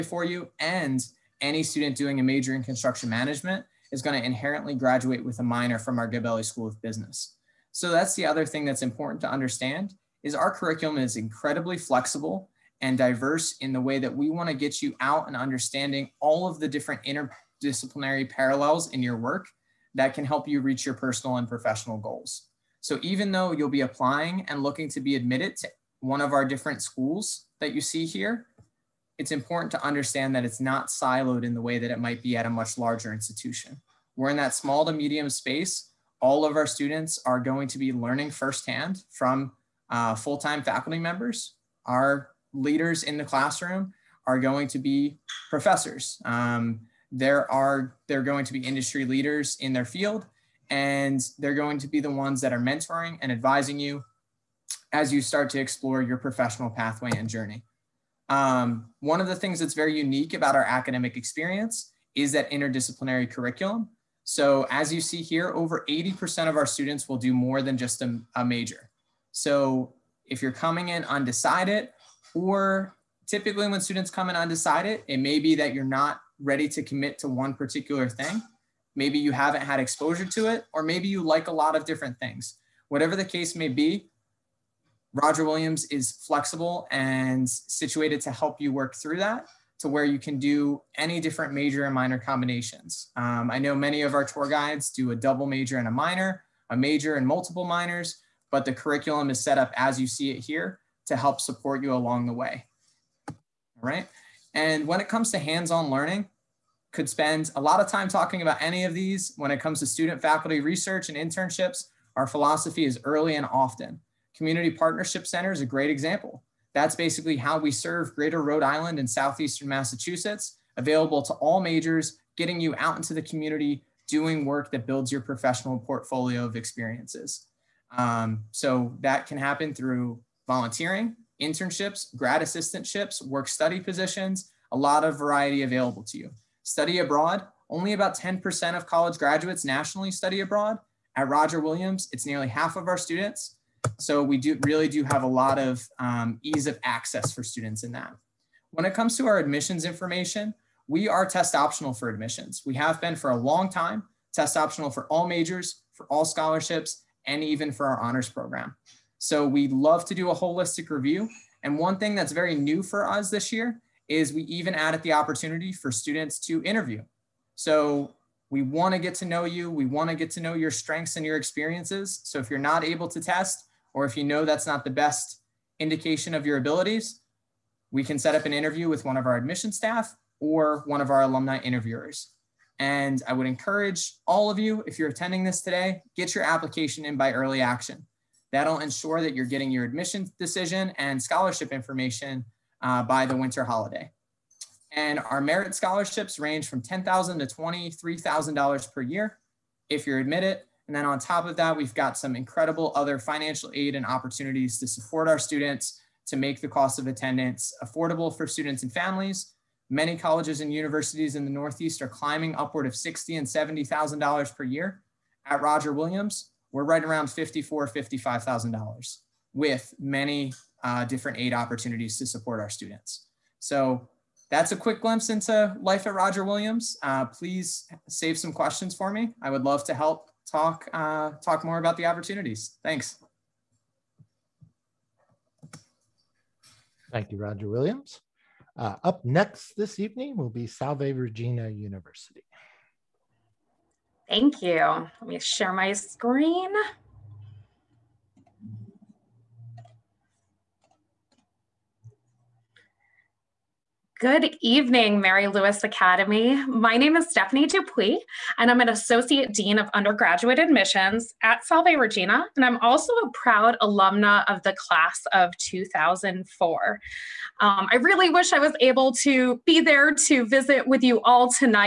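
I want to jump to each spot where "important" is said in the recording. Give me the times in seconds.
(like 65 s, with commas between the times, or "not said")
8 s, 29 s.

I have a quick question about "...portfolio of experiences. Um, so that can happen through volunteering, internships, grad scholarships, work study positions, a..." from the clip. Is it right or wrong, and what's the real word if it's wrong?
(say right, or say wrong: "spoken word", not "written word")
wrong: "assistantships", not "scholarships".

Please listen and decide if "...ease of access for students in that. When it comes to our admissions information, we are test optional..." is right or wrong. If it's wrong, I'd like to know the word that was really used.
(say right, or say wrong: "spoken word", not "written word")
right.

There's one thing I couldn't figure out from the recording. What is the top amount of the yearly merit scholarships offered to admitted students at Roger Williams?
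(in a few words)
$23,000.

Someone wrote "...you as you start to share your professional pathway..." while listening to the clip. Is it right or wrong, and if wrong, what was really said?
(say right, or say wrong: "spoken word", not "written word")
wrong: "explore", not "share".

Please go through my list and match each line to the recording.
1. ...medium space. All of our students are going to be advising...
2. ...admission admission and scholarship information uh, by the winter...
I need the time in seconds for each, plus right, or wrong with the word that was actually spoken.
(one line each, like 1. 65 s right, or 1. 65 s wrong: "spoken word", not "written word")
1. 34 s wrong: "learning", not "advising"
2. 189 s wrong: "decision", not "admission".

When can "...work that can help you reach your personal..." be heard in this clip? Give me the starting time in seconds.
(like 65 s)
19 s.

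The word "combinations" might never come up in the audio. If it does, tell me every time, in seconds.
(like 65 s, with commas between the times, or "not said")
92 s.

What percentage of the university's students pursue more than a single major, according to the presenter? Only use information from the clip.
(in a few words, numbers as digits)
over 80%.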